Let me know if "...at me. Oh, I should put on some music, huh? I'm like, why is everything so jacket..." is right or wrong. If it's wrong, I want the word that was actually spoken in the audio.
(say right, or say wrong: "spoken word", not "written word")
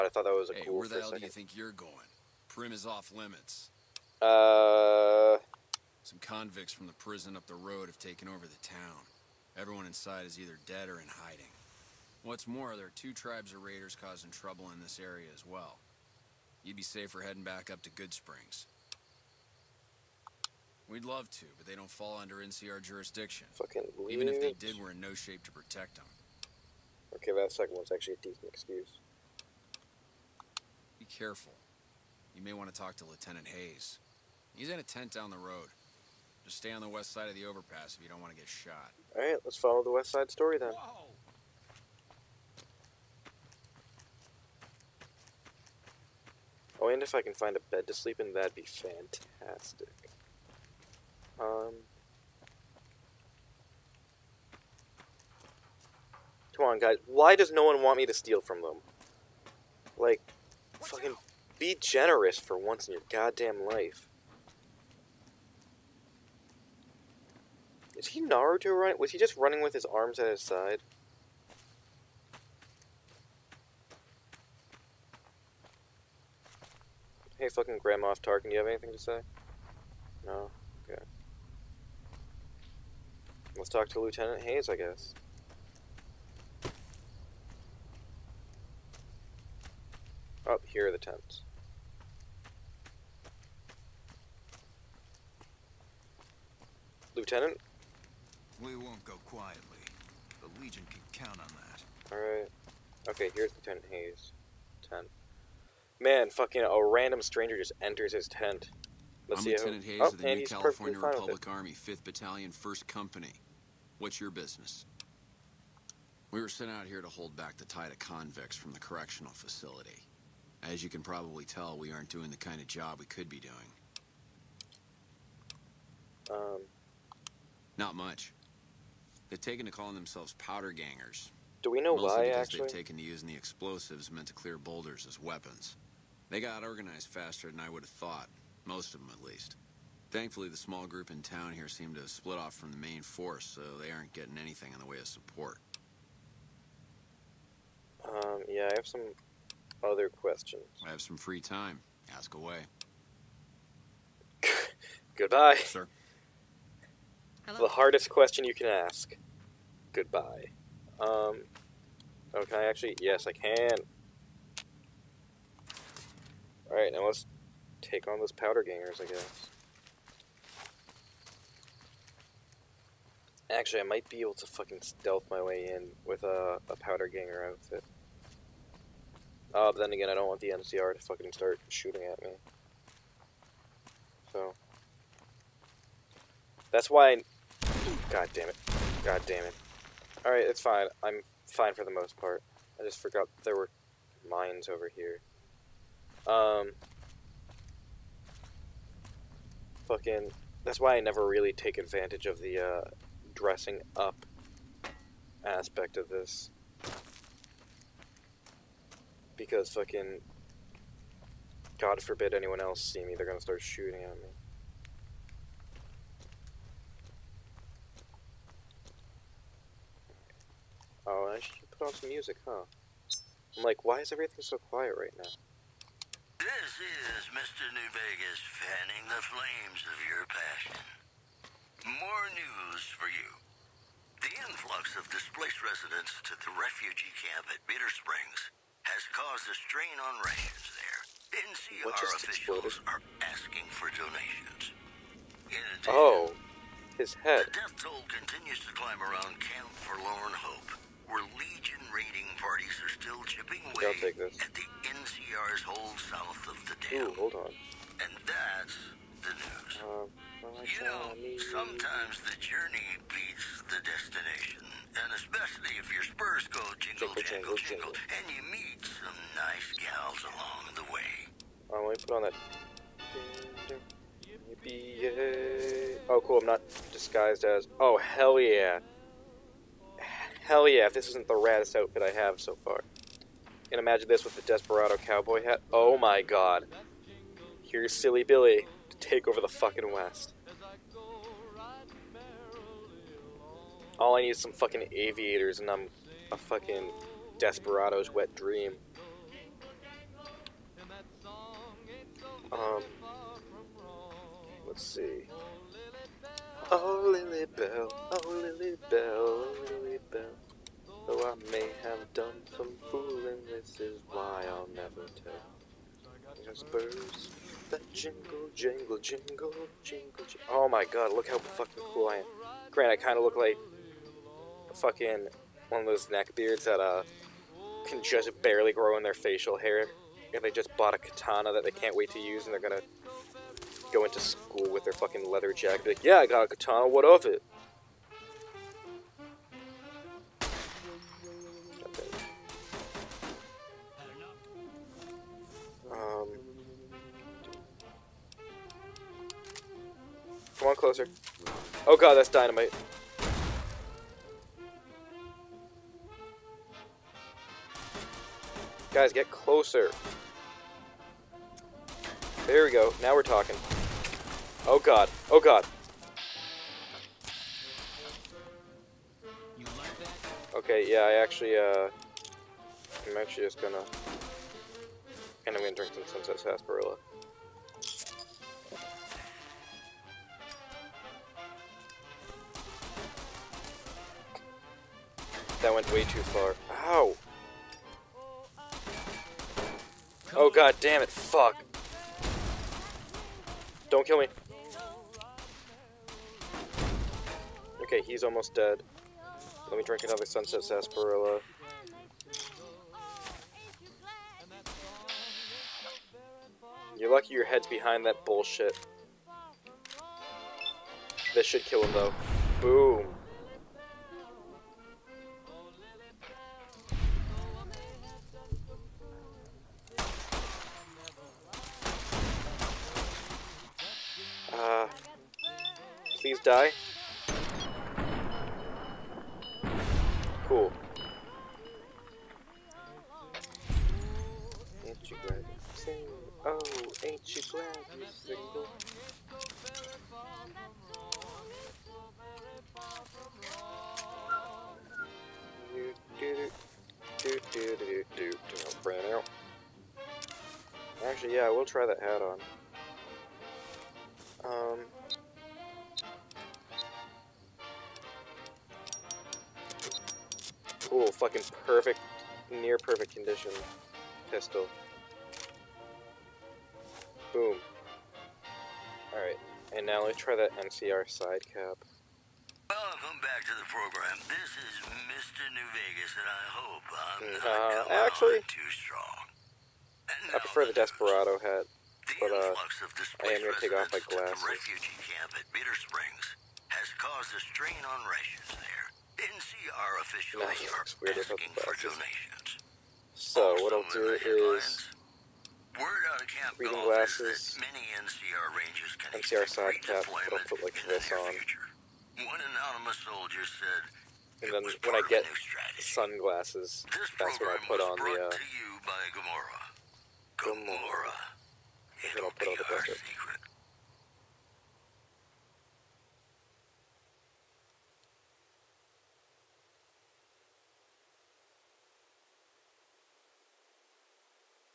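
wrong: "quiet", not "jacket".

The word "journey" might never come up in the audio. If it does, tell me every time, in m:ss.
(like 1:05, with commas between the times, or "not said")
4:22.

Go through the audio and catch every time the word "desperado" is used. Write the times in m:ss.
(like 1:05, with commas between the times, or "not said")
4:44, 4:57, 8:00.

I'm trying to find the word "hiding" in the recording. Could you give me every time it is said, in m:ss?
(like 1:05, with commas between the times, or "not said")
0:11.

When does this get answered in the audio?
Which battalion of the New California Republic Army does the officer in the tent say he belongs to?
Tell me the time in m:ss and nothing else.
1:51.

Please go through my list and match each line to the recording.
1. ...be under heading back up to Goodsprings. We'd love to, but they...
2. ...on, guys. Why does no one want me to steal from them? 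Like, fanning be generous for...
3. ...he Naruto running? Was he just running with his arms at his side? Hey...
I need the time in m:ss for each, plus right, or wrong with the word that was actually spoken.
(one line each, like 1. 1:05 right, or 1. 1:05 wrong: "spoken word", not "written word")
1. 0:16 wrong: "safer", not "under"
2. 0:56 wrong: "fucking", not "fanning"
3. 1:08 right.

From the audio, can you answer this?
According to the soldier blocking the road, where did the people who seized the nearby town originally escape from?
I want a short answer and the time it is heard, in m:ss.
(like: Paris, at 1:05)
the prison up the road, at 0:06.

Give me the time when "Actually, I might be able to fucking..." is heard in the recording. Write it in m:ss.
2:53.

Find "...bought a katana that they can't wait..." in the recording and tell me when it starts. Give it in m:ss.
5:30.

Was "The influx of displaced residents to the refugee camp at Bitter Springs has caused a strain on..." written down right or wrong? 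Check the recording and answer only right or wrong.
right.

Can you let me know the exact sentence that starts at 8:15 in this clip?
Word out of camp reading glasses.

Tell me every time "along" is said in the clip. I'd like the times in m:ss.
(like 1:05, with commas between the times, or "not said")
4:30.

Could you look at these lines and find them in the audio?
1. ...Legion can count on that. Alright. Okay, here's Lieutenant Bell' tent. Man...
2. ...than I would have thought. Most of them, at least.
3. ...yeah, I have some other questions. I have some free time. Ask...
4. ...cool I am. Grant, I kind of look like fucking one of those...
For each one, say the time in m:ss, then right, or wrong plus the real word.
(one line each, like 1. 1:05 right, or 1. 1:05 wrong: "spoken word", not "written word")
1. 1:40 wrong: "Hayes", not "Bell"
2. 2:17 right
3. 2:28 right
4. 5:21 right.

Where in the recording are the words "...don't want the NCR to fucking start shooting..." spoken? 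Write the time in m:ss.
3:00.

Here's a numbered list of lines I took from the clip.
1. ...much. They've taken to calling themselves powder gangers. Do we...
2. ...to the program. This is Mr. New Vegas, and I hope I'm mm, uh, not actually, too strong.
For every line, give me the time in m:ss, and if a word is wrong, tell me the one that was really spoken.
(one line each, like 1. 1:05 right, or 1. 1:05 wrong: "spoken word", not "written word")
1. 2:07 right
2. 7:53 right.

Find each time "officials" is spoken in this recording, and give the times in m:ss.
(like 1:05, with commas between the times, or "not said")
4:01, 8:10.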